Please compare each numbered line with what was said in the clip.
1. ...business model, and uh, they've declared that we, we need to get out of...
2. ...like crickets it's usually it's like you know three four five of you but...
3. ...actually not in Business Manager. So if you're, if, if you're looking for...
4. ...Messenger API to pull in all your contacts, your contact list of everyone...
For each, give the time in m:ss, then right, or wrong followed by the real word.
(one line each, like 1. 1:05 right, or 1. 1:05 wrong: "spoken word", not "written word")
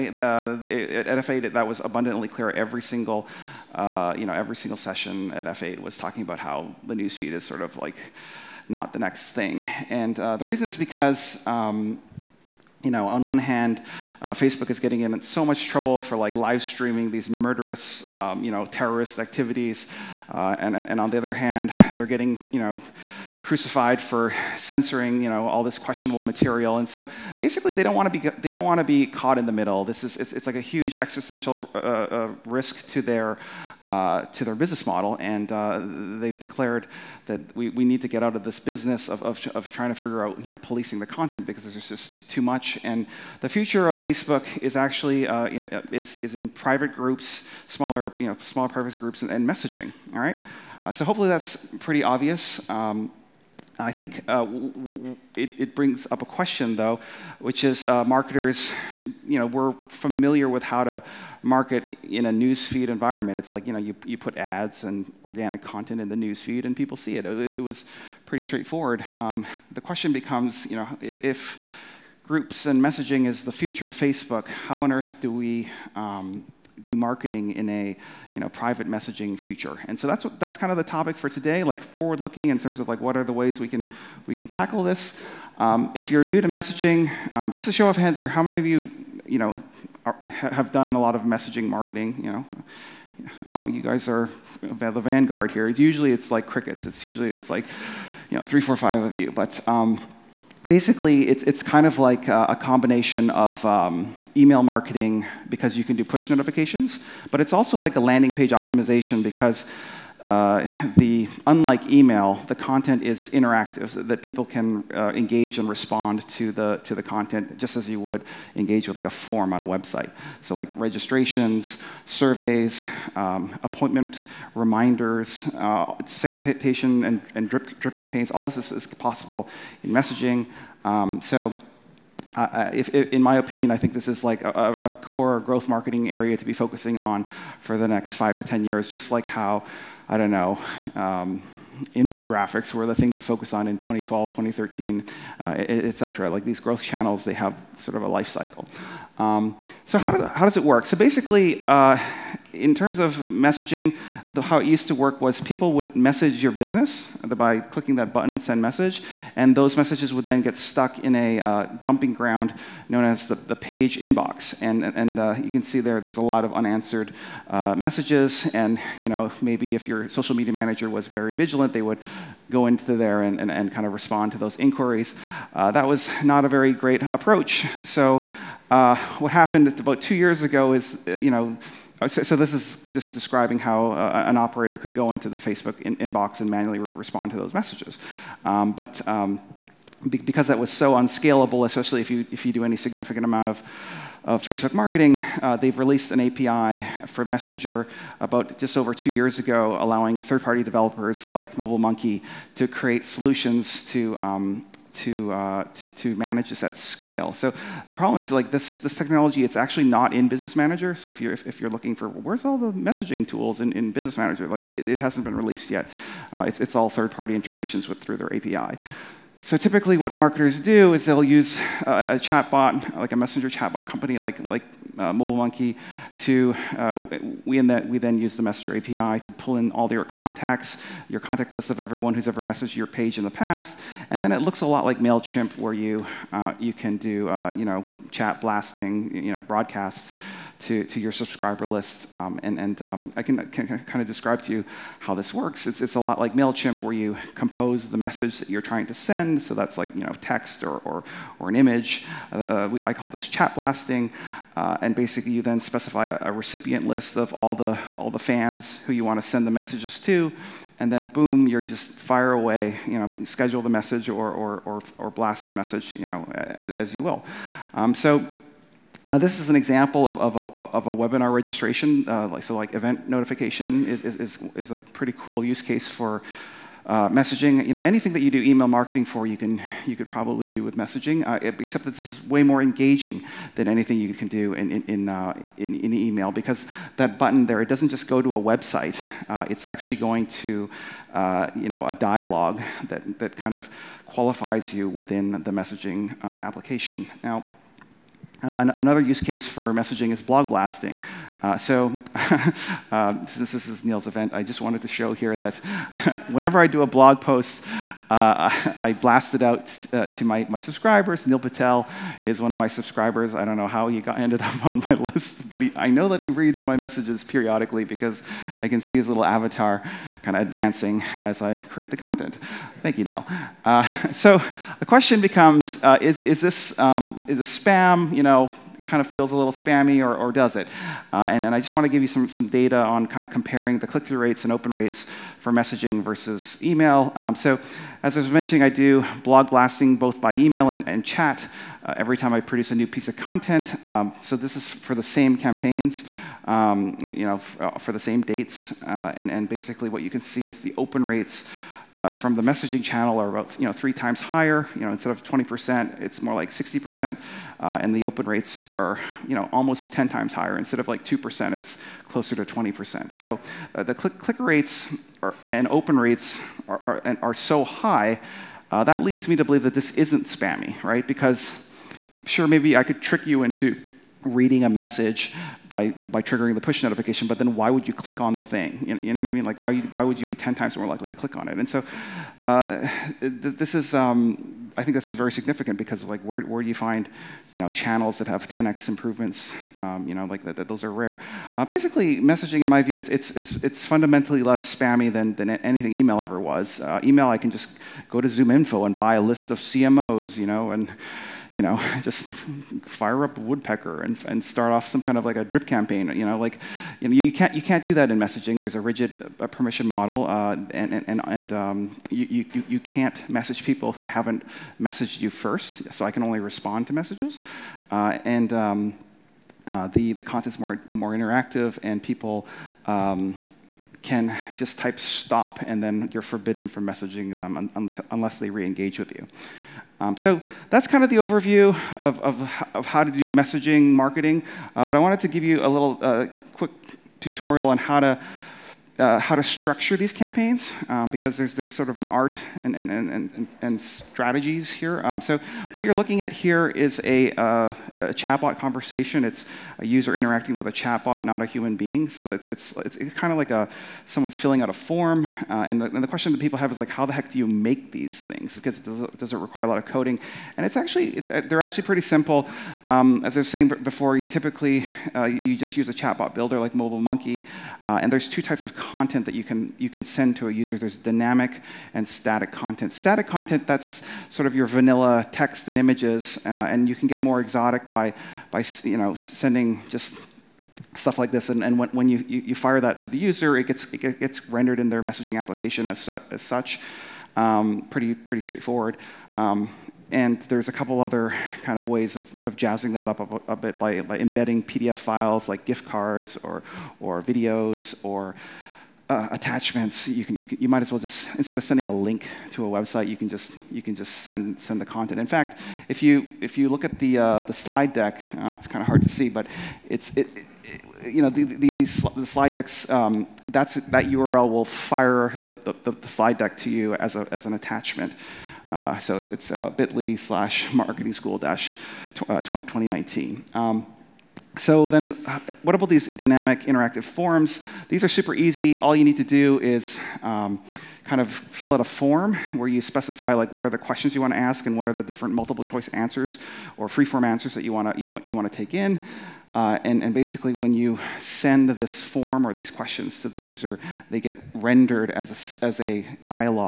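1. 0:34 right
2. 1:36 right
3. 3:29 right
4. 3:48 right.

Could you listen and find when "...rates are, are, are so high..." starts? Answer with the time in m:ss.
6:05.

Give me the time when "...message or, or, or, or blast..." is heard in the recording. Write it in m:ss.
4:23.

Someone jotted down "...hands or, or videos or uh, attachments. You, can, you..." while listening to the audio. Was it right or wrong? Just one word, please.
wrong.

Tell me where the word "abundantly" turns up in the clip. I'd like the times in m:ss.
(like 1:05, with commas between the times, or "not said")
0:01.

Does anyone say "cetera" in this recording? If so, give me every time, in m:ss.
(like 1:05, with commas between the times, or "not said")
2:25.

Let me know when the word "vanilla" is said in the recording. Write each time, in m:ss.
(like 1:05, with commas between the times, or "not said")
7:54.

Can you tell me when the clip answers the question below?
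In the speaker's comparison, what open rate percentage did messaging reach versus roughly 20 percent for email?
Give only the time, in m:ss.
5:56.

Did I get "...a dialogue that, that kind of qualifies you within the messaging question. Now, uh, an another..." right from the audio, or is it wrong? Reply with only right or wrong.
wrong.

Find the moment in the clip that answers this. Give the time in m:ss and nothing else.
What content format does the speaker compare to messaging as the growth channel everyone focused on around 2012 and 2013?
2:21.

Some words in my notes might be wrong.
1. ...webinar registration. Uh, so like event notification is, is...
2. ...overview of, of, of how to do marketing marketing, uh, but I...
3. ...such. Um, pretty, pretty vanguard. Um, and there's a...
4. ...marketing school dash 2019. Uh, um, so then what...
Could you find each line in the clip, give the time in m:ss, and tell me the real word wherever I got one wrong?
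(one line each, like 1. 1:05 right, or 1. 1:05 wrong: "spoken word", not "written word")
1. 4:30 right
2. 7:11 wrong: "messaging", not "marketing"
3. 8:06 wrong: "straightforward", not "vanguard"
4. 8:40 right.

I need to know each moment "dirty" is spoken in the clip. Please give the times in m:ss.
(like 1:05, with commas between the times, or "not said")
not said.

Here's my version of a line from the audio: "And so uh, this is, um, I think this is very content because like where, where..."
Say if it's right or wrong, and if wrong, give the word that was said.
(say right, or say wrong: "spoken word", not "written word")
wrong: "significant", not "content".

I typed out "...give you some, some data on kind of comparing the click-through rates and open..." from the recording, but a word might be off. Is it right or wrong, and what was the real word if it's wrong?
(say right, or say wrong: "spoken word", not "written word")
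right.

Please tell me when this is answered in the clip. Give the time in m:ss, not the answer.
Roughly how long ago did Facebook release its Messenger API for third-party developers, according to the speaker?
3:18.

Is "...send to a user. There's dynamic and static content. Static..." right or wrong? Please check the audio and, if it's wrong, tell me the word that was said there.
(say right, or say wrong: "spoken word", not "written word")
right.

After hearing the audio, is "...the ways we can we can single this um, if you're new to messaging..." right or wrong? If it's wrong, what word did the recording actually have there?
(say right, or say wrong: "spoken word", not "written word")
wrong: "tackle", not "single".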